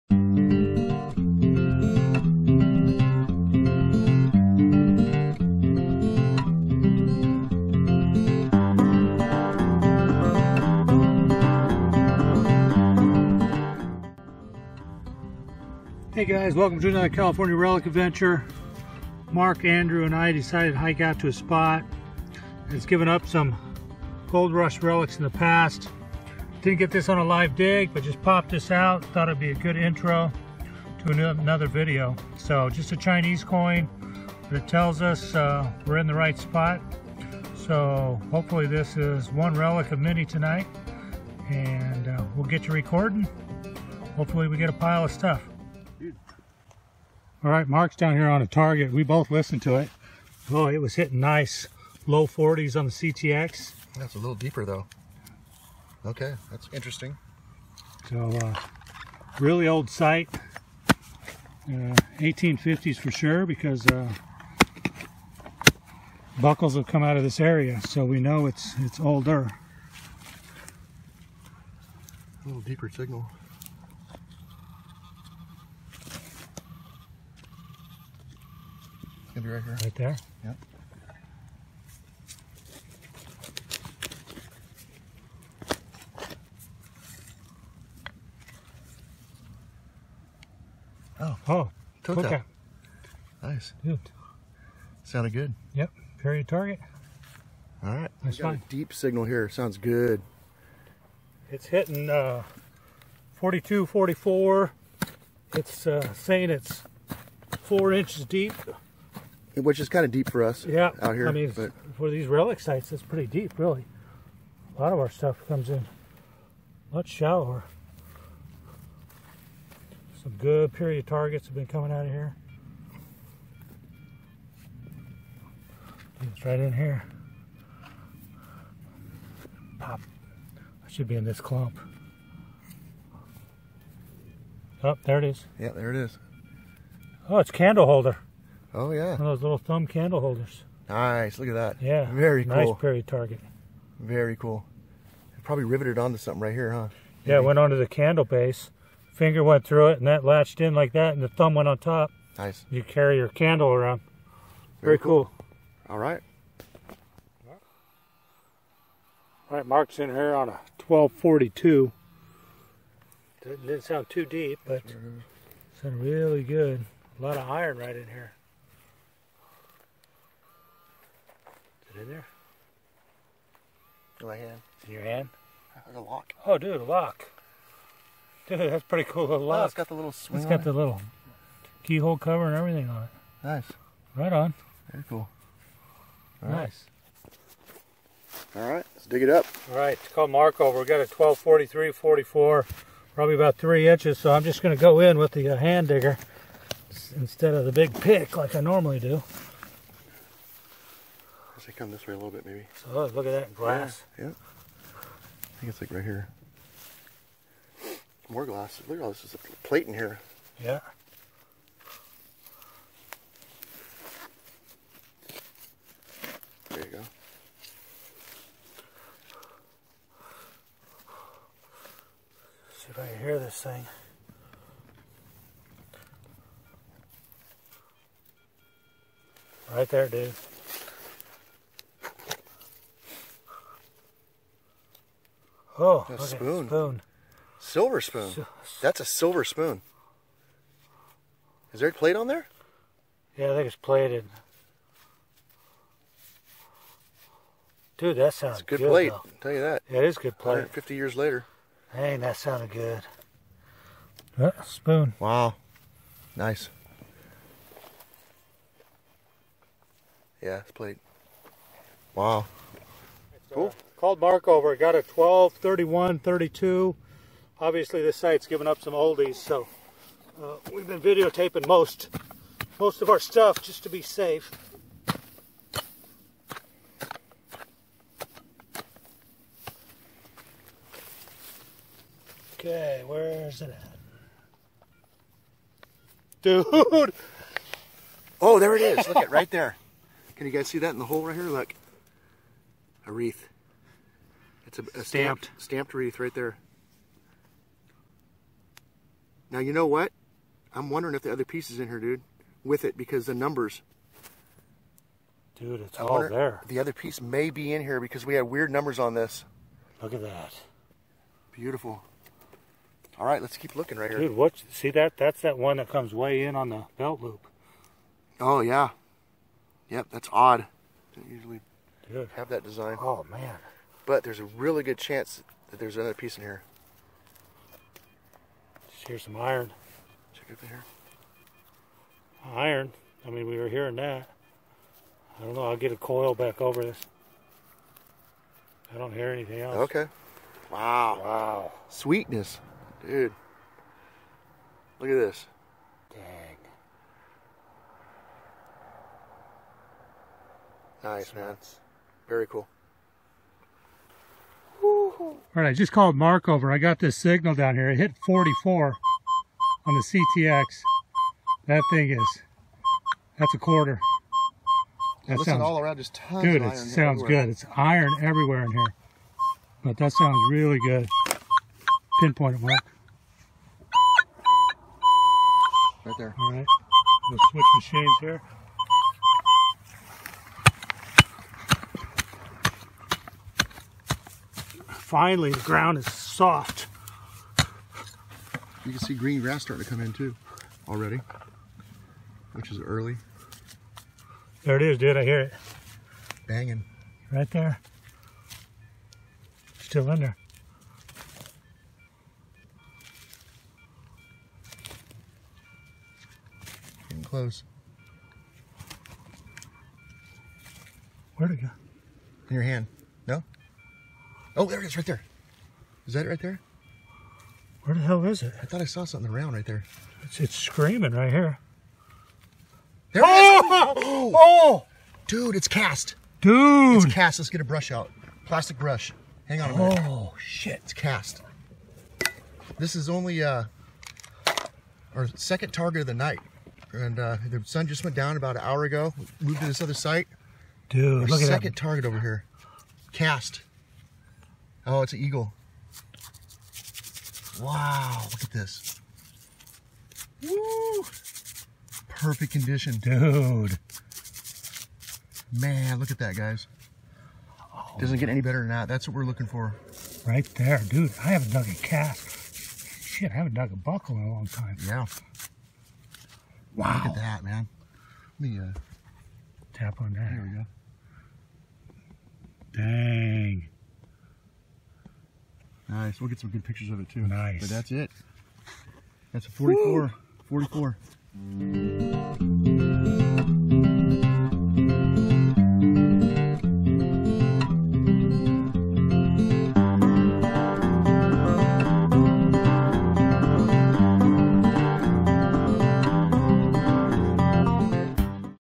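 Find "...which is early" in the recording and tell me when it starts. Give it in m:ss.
6:32.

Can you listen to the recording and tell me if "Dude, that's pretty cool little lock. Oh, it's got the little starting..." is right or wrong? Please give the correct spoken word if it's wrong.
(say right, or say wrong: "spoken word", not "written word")
wrong: "swing", not "starting".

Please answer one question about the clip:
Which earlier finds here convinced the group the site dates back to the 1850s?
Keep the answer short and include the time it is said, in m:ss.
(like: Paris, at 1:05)
buckles, at 1:06.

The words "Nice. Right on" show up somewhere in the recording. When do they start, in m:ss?
3:03.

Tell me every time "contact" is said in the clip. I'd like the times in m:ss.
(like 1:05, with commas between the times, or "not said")
not said.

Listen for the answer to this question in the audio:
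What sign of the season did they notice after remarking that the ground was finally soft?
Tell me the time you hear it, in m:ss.
6:29.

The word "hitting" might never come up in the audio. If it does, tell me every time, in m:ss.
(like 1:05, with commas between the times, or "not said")
0:50, 1:41.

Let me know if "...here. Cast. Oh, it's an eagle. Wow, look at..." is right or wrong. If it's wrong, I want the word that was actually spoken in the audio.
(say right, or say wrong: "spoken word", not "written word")
right.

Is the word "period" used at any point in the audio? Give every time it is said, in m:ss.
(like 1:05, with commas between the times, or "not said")
1:36, 2:00.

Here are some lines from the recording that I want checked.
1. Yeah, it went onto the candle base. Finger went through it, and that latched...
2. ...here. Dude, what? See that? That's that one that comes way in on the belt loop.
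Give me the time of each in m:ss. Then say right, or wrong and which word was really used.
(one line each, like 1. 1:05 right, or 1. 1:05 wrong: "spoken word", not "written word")
1. 2:27 right
2. 5:14 right.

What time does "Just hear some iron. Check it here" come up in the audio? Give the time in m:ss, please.
5:28.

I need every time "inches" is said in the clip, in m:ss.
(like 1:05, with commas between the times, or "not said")
1:47, 3:13.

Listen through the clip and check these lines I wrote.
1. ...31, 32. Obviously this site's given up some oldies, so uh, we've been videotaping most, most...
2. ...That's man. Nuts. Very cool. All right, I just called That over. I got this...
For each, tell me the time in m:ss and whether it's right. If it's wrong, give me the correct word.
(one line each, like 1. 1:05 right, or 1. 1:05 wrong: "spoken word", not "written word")
1. 4:25 right
2. 5:51 wrong: "Mark", not "That".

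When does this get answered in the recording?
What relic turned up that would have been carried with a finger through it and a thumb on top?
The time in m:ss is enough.
2:17.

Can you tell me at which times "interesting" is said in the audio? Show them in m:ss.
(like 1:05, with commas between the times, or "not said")
0:56.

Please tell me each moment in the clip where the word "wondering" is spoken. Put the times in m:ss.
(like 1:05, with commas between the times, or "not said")
5:00.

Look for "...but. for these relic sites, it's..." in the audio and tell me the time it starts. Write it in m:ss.
1:51.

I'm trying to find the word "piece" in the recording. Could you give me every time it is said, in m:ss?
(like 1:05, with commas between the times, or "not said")
5:01, 5:06, 5:26.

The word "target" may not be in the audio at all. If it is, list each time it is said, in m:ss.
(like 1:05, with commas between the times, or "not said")
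0:48, 1:36, 2:01, 2:23, 7:15, 7:21.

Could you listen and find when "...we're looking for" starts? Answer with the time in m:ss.
7:39.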